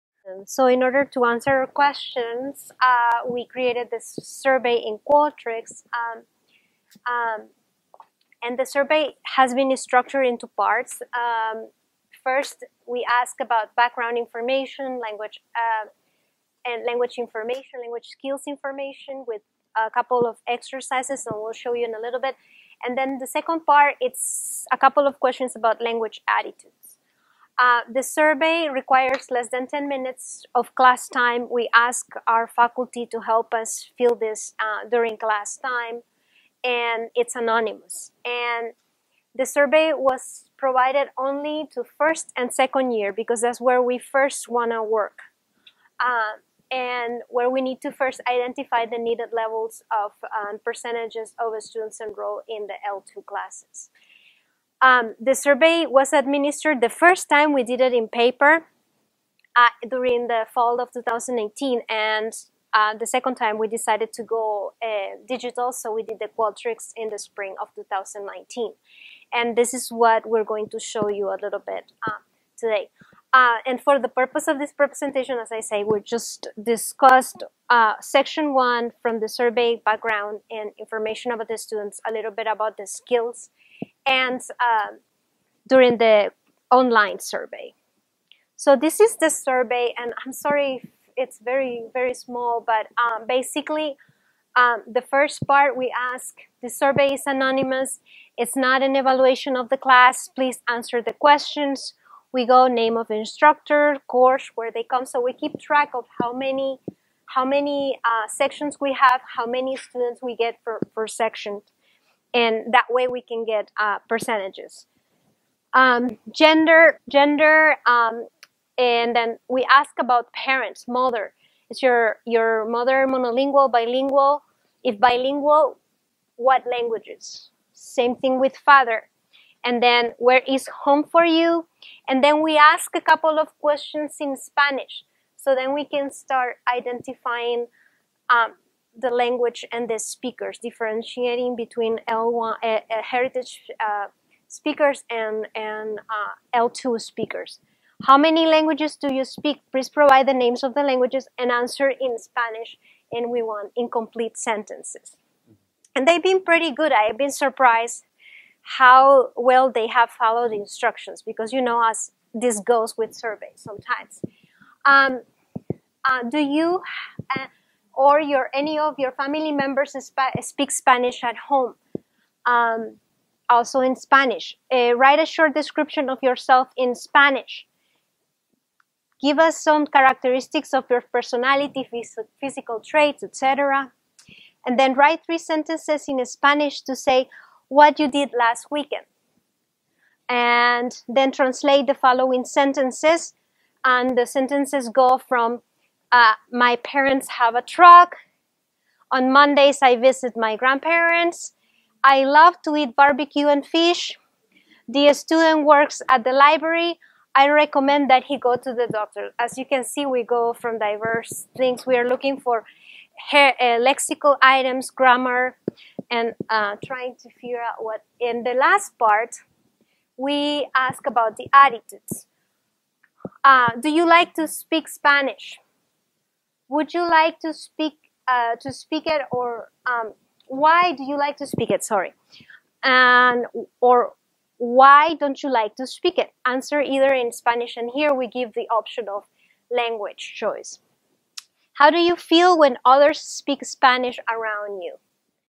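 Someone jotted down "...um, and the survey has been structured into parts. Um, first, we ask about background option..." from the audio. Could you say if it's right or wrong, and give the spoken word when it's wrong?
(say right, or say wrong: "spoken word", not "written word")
wrong: "information", not "option".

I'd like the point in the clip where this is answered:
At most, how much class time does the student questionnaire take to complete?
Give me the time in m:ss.
0:29.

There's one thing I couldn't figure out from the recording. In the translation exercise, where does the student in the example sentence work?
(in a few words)
the library.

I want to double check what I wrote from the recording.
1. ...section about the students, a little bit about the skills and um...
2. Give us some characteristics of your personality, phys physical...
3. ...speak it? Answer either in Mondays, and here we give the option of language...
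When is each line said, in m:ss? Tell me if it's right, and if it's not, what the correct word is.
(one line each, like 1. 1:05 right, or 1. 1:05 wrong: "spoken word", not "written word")
1. 1:20 wrong: "information", not "section"
2. 2:59 right
3. 3:55 wrong: "Spanish", not "Mondays".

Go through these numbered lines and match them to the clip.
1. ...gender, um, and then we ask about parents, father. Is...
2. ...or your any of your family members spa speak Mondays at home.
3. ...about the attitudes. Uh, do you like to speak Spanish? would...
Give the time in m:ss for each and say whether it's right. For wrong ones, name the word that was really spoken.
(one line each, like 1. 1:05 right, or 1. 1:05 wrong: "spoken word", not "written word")
1. 1:57 wrong: "mother", not "father"
2. 2:47 wrong: "Spanish", not "Mondays"
3. 3:41 right.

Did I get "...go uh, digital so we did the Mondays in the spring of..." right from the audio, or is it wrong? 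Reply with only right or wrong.
wrong.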